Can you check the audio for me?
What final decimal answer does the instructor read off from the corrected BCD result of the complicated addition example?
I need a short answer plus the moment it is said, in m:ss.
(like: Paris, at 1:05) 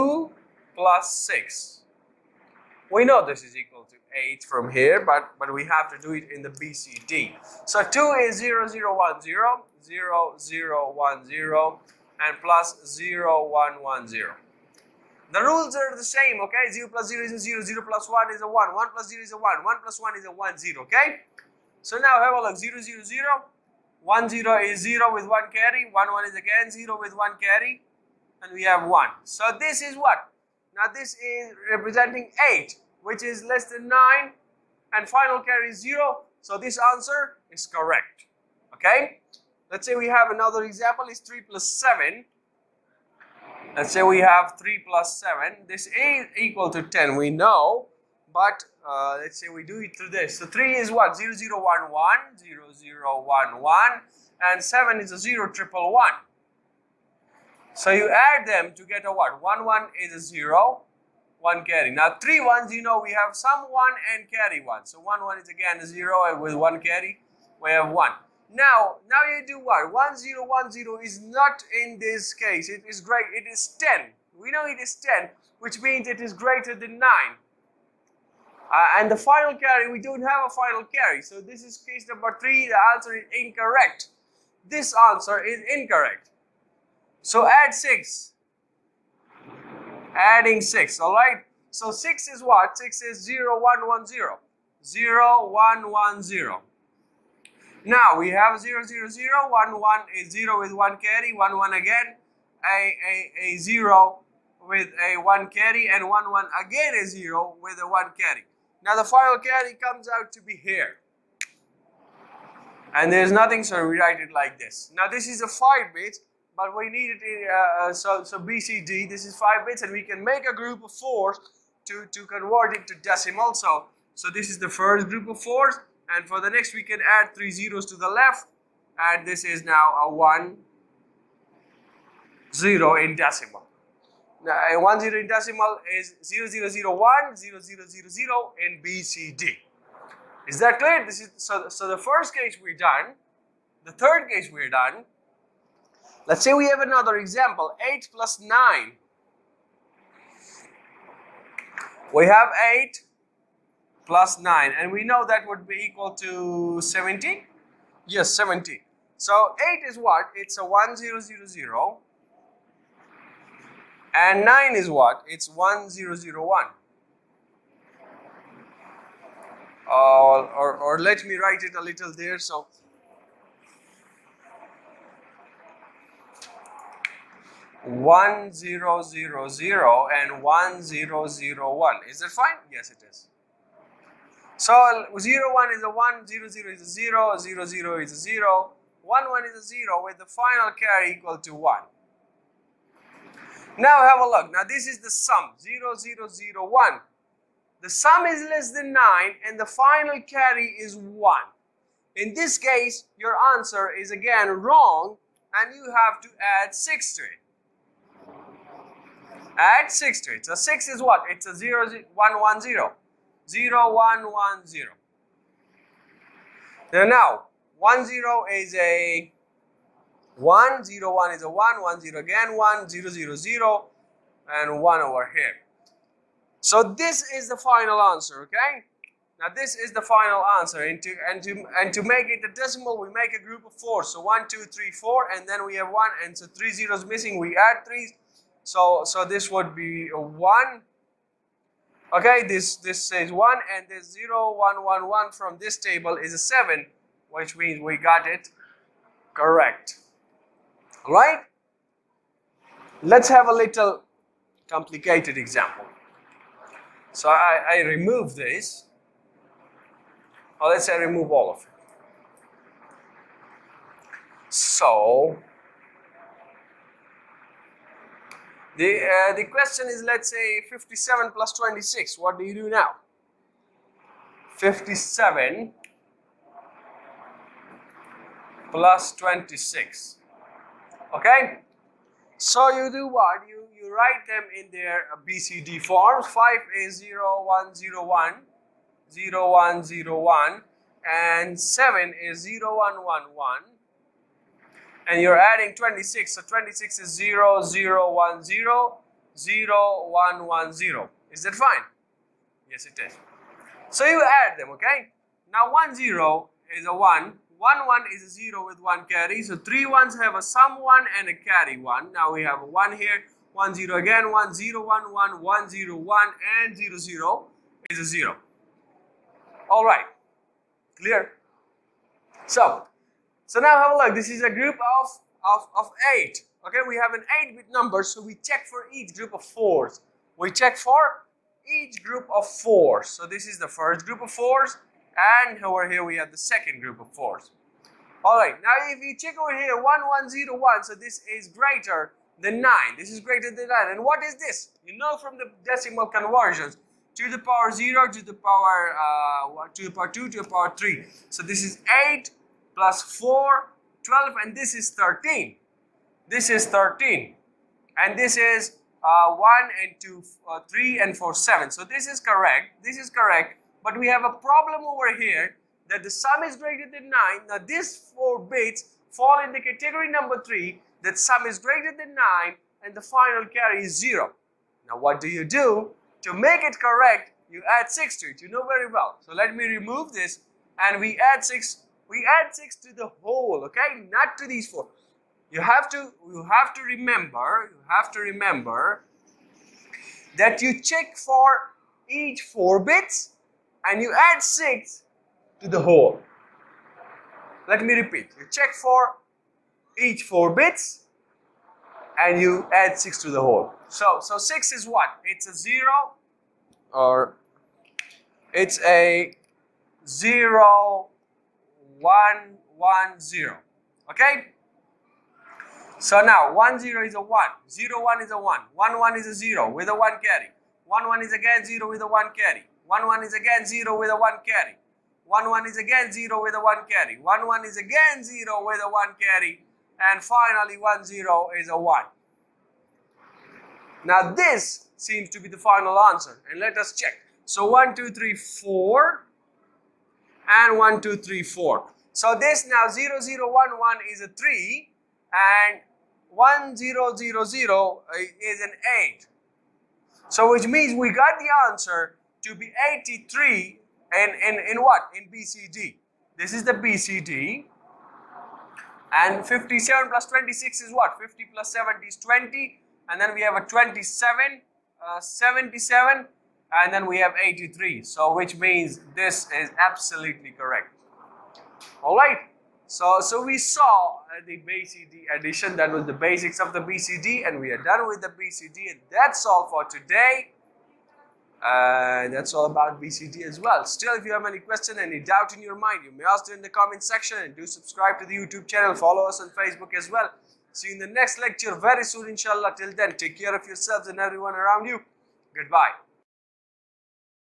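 83, at 7:30.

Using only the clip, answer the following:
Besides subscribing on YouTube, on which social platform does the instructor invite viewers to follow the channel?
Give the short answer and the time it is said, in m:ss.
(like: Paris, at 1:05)
Facebook, at 8:08.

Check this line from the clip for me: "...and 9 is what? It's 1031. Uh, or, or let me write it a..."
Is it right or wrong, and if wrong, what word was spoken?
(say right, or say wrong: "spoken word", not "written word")
wrong: "1001", not "1031".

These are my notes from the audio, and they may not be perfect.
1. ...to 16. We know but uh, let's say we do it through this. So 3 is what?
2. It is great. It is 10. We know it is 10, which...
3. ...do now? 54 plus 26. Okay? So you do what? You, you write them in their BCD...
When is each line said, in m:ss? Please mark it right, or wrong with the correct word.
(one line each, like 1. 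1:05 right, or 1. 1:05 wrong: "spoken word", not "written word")
1. 0:46 wrong: "10", not "16"
2. 1:12 right
3. 4:32 wrong: "57", not "54".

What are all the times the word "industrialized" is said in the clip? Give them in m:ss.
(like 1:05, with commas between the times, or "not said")
not said.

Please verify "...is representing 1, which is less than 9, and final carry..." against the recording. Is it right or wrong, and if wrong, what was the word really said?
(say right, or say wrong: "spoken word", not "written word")
wrong: "8", not "1".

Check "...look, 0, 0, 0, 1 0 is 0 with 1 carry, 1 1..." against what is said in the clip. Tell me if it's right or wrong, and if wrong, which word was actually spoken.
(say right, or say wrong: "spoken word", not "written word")
right.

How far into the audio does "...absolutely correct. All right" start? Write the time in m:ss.
7:49.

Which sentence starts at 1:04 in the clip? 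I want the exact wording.
So 1, 1 is again a 0, and with 1 carry, we have 1.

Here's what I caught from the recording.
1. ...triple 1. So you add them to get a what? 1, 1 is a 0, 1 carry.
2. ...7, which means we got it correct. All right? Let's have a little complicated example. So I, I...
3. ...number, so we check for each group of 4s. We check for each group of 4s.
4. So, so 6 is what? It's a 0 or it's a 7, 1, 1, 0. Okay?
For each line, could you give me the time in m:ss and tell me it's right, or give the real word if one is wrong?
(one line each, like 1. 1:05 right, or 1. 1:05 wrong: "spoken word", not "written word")
1. 0:55 right
2. 4:06 right
3. 5:27 right
4. 6:43 wrong: "0", not "7".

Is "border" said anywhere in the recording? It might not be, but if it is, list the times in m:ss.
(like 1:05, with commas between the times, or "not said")
not said.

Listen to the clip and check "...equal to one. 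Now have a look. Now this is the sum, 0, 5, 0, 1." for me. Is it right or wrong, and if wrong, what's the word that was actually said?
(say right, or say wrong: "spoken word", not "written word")
wrong: "0", not "5".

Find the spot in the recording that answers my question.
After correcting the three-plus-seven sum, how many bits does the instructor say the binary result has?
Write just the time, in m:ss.
1:55.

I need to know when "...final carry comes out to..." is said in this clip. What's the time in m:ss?
1:49.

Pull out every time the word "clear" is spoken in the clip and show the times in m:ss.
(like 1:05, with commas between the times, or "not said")
2:20, 5:20.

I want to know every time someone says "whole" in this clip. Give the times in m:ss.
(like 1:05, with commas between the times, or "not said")
6:23, 6:35, 6:43.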